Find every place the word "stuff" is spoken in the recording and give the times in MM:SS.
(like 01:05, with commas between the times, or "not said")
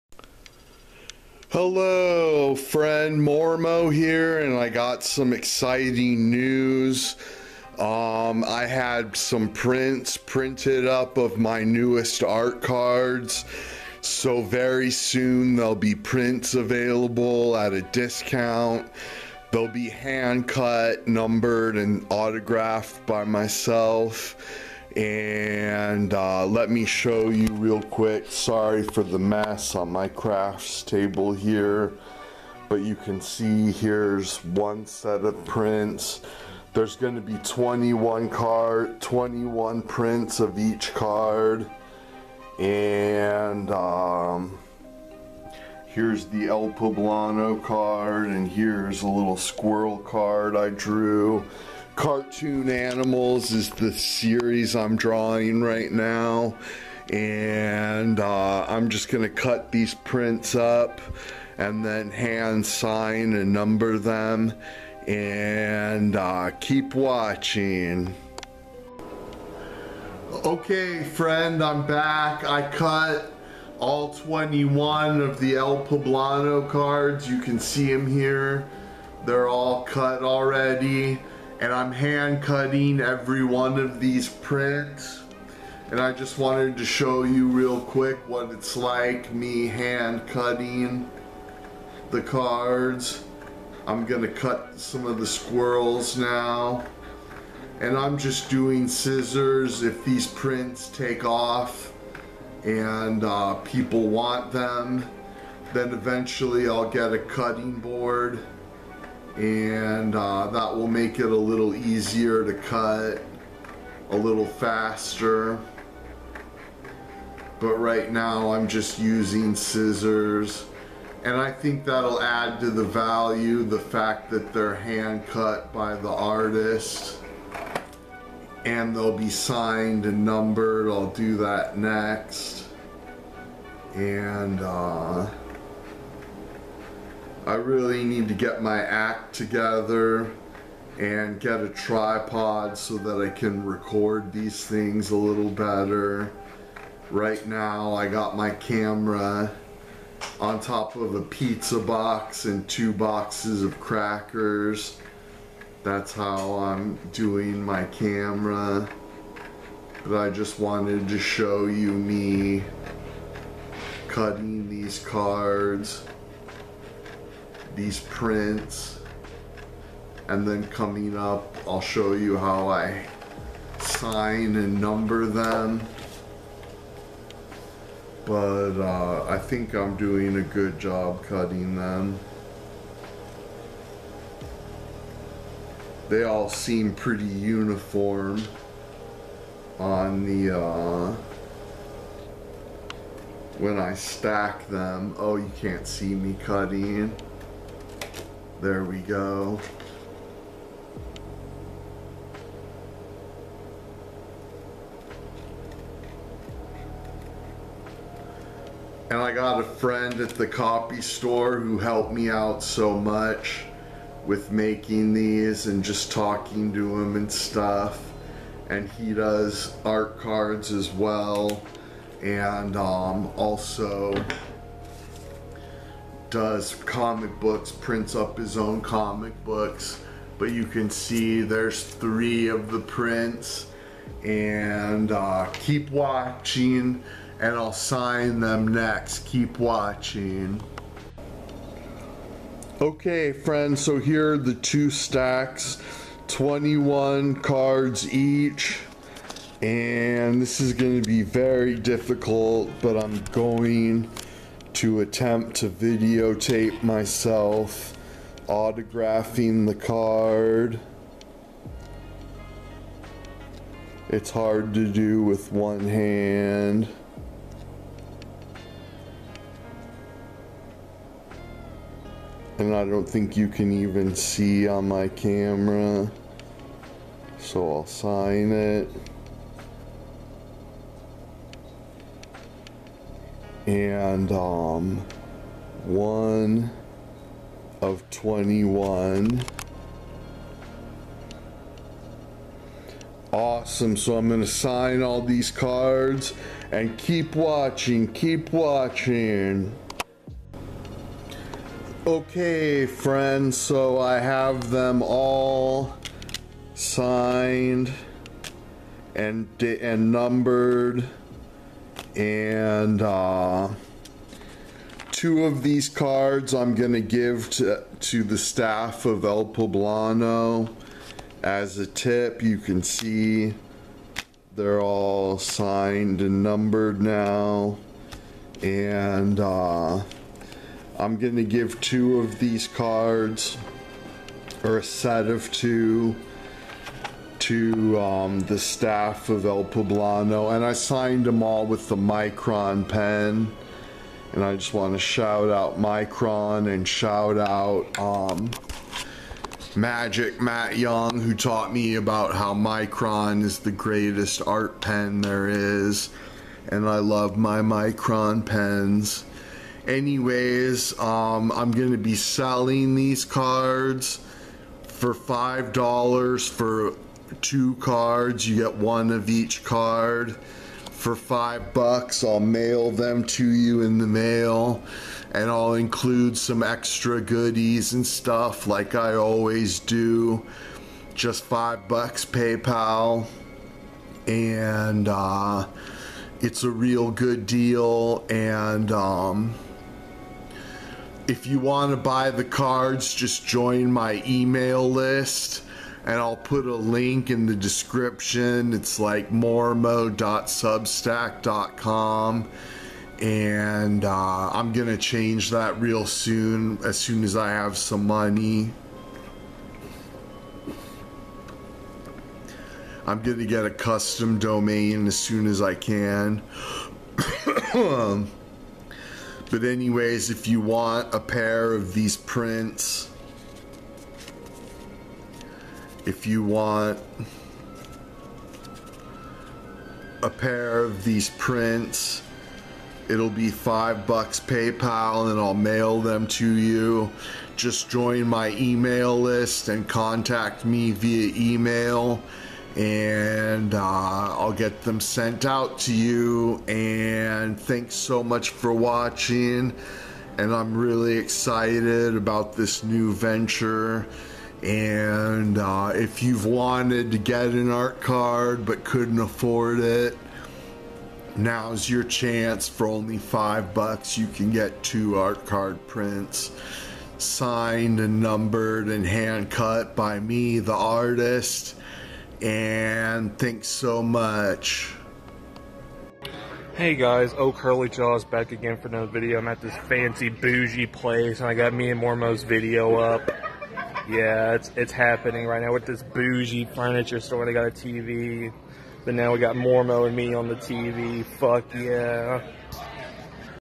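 03:37, 06:18.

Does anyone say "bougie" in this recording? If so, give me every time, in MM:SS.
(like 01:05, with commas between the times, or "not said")
08:00, 08:06.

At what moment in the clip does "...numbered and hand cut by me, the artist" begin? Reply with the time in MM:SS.
07:48.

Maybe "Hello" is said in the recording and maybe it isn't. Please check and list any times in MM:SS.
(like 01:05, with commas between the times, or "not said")
00:01.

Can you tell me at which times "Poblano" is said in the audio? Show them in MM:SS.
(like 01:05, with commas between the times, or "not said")
00:46, 01:15, 05:19, 05:39.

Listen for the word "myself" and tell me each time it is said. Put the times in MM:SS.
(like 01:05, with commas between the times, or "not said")
00:23, 04:16.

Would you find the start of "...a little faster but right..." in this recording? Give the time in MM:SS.
01:54.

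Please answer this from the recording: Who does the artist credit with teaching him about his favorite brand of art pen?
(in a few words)
Magic Matt Young.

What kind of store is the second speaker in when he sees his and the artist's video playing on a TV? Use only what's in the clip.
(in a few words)
furniture store.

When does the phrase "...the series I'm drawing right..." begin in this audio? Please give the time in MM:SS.
00:53.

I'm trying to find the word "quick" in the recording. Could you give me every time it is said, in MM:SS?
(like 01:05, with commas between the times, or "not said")
00:27, 01:27.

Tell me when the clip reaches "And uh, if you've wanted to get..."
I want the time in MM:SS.
07:34.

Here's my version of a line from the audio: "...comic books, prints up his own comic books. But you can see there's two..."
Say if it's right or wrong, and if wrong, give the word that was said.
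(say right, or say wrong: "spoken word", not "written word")
wrong: "three", not "two".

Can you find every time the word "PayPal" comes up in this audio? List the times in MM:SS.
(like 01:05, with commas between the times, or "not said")
06:22, 07:14.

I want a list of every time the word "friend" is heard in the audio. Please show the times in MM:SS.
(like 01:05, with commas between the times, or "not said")
00:02, 01:11, 03:29, 04:03, 05:02.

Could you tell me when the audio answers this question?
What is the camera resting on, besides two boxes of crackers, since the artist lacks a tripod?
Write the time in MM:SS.
02:31.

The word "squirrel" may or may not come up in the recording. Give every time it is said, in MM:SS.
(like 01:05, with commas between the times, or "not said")
00:49, 01:35.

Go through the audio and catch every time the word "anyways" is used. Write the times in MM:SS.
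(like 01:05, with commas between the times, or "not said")
05:59, 06:59.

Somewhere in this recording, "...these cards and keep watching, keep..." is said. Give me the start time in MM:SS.
04:55.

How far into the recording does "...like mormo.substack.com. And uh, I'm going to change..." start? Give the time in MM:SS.
06:38.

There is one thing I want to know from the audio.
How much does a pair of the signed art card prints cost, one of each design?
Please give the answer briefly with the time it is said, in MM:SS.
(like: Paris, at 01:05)
$5, at 06:05.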